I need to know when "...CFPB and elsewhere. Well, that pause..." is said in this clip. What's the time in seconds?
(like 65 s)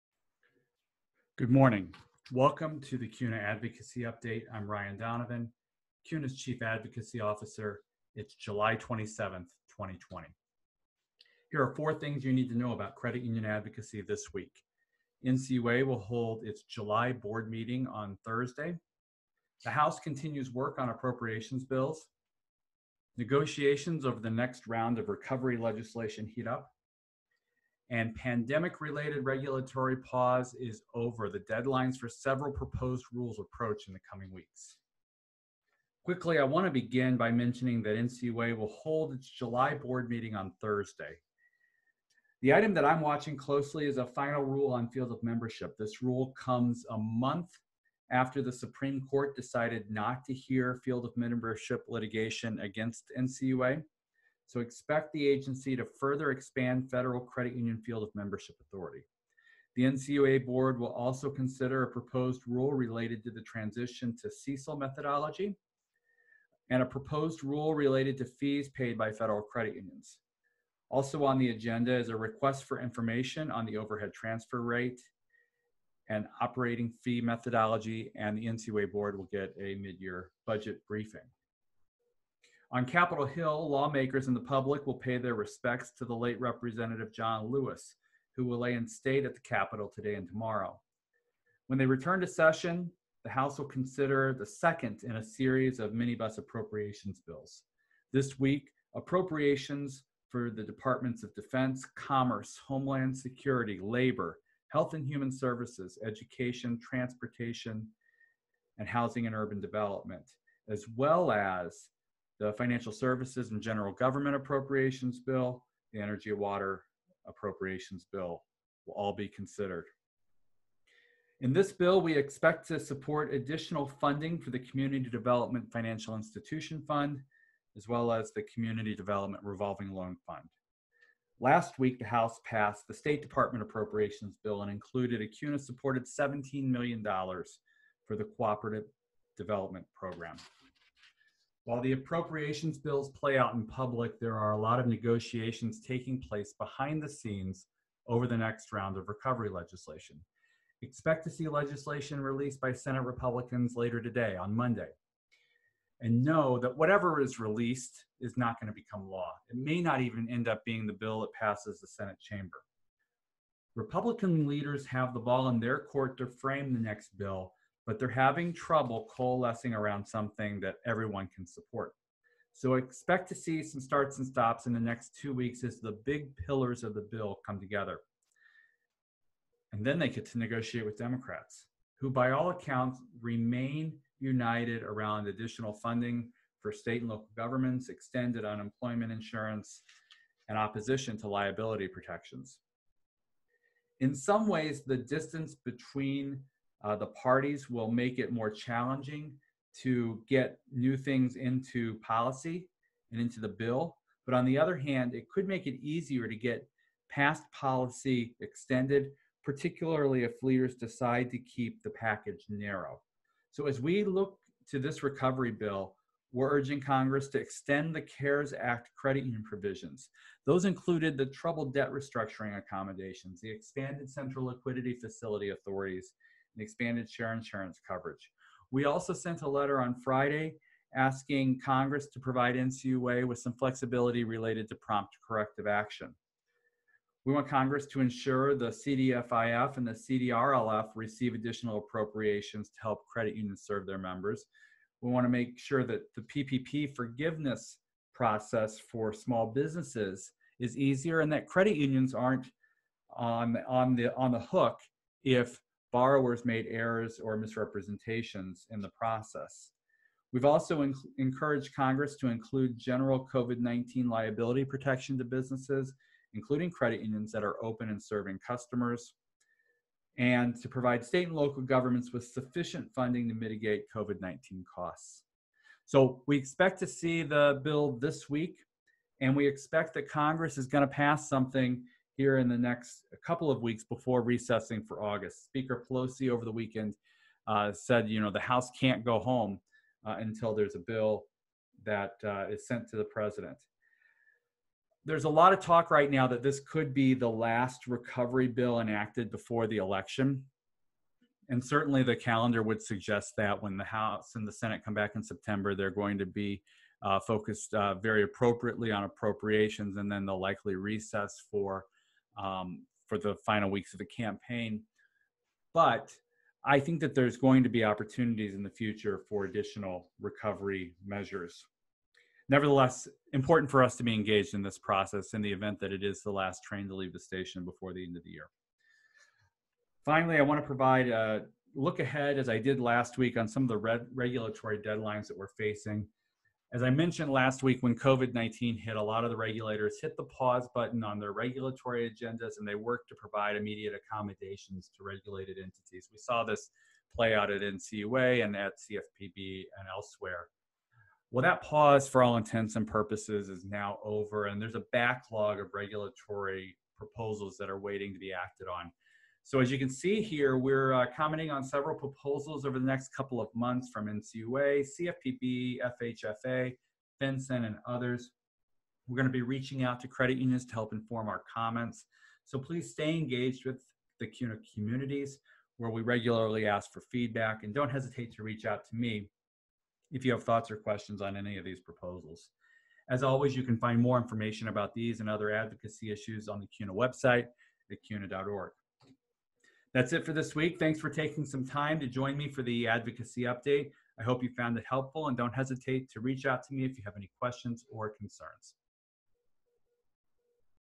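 348 s.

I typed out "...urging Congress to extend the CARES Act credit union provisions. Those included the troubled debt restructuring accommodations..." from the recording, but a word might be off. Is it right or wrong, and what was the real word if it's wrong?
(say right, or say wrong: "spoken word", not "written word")
right.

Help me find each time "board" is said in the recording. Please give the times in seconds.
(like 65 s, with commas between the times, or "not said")
17 s, 39 s, 60 s, 78 s.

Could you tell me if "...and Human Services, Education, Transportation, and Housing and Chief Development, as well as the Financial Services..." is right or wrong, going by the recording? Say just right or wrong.
wrong.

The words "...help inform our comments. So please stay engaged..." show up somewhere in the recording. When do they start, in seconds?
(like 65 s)
370 s.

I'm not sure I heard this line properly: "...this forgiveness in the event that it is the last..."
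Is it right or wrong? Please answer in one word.
wrong.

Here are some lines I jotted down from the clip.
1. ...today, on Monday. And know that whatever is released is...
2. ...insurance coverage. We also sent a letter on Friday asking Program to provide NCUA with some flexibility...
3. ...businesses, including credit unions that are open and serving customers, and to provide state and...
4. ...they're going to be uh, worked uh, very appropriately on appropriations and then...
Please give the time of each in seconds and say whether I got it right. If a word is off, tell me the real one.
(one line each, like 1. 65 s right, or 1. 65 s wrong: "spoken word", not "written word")
1. 154 s right
2. 227 s wrong: "Congress", not "Program"
3. 265 s right
4. 305 s wrong: "focused", not "worked".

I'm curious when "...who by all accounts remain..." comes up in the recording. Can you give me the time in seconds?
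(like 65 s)
181 s.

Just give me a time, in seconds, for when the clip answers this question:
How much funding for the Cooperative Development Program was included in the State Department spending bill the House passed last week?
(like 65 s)
136 s.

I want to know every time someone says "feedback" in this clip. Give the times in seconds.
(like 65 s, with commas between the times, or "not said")
377 s.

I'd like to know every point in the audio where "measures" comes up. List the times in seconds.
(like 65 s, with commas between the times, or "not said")
321 s.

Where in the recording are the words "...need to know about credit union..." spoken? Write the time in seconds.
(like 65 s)
12 s.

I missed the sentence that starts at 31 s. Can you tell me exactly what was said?
The deadlines for several proposed rules approach in the coming weeks.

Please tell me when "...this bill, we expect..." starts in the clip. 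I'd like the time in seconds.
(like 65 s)
121 s.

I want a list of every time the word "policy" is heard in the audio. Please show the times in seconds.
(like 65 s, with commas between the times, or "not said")
201 s, 207 s.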